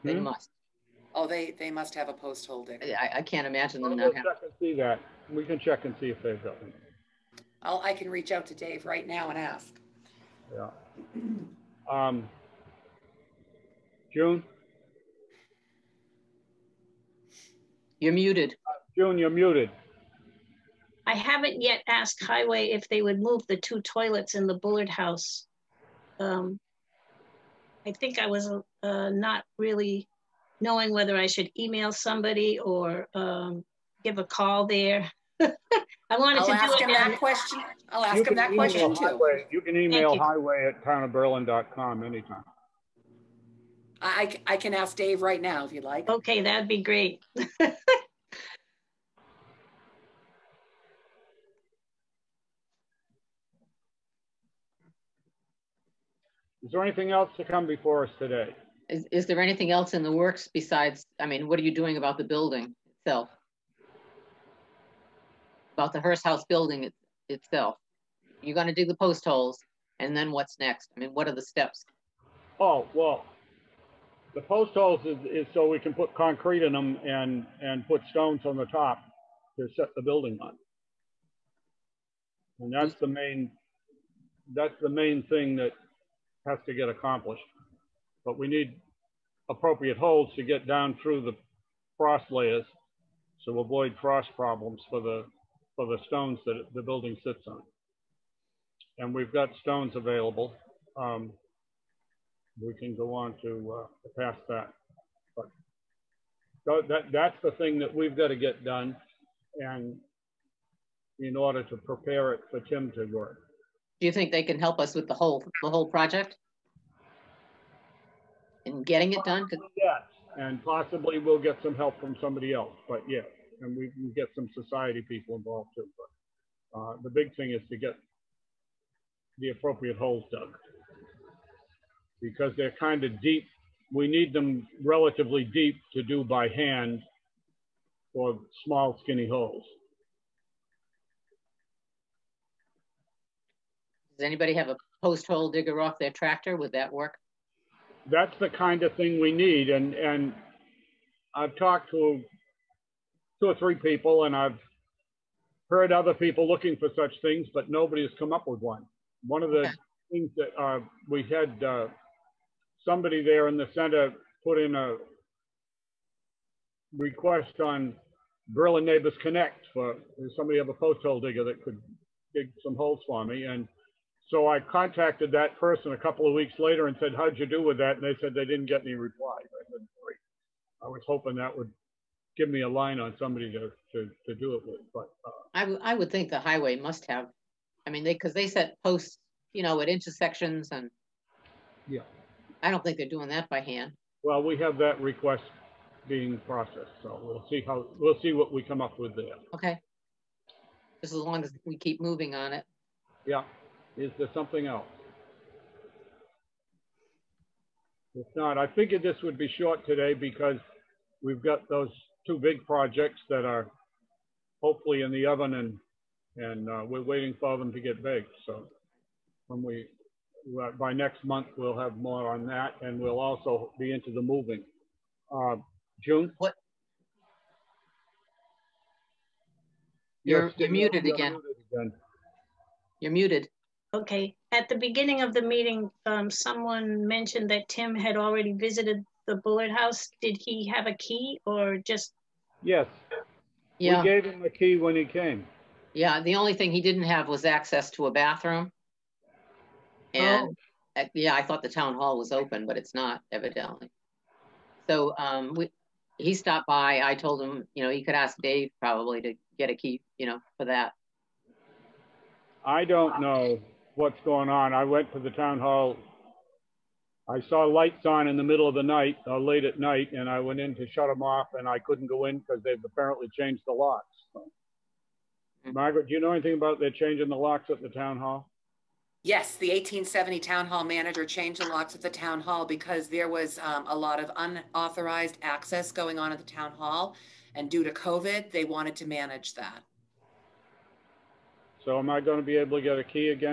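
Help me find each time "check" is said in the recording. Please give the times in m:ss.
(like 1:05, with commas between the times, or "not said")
0:05.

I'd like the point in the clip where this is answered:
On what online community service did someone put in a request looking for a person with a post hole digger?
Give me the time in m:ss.
2:48.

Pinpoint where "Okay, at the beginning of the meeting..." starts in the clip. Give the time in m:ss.
3:53.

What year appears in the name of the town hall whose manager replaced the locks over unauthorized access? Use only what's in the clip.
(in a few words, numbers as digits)
1870.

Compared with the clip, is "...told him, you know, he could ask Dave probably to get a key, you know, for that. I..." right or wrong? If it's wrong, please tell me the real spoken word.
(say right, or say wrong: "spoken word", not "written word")
right.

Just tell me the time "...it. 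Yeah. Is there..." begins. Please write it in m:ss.
3:22.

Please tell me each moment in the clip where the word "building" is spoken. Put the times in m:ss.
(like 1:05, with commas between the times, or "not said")
1:02, 1:06, 1:20, 1:36.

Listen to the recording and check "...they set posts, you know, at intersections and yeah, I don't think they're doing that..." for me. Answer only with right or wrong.
right.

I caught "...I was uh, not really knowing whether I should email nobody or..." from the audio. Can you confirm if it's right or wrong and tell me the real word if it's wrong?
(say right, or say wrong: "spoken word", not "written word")
wrong: "somebody", not "nobody".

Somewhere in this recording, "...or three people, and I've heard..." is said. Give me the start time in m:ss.
2:33.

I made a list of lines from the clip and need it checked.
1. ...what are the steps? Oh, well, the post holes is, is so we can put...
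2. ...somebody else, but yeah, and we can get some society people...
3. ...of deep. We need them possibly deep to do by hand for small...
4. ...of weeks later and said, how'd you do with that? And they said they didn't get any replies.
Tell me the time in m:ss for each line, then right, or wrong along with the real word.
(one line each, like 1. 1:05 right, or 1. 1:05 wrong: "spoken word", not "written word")
1. 1:11 right
2. 2:02 right
3. 2:13 wrong: "relatively", not "possibly"
4. 2:56 right.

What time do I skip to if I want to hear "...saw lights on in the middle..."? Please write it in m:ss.
4:27.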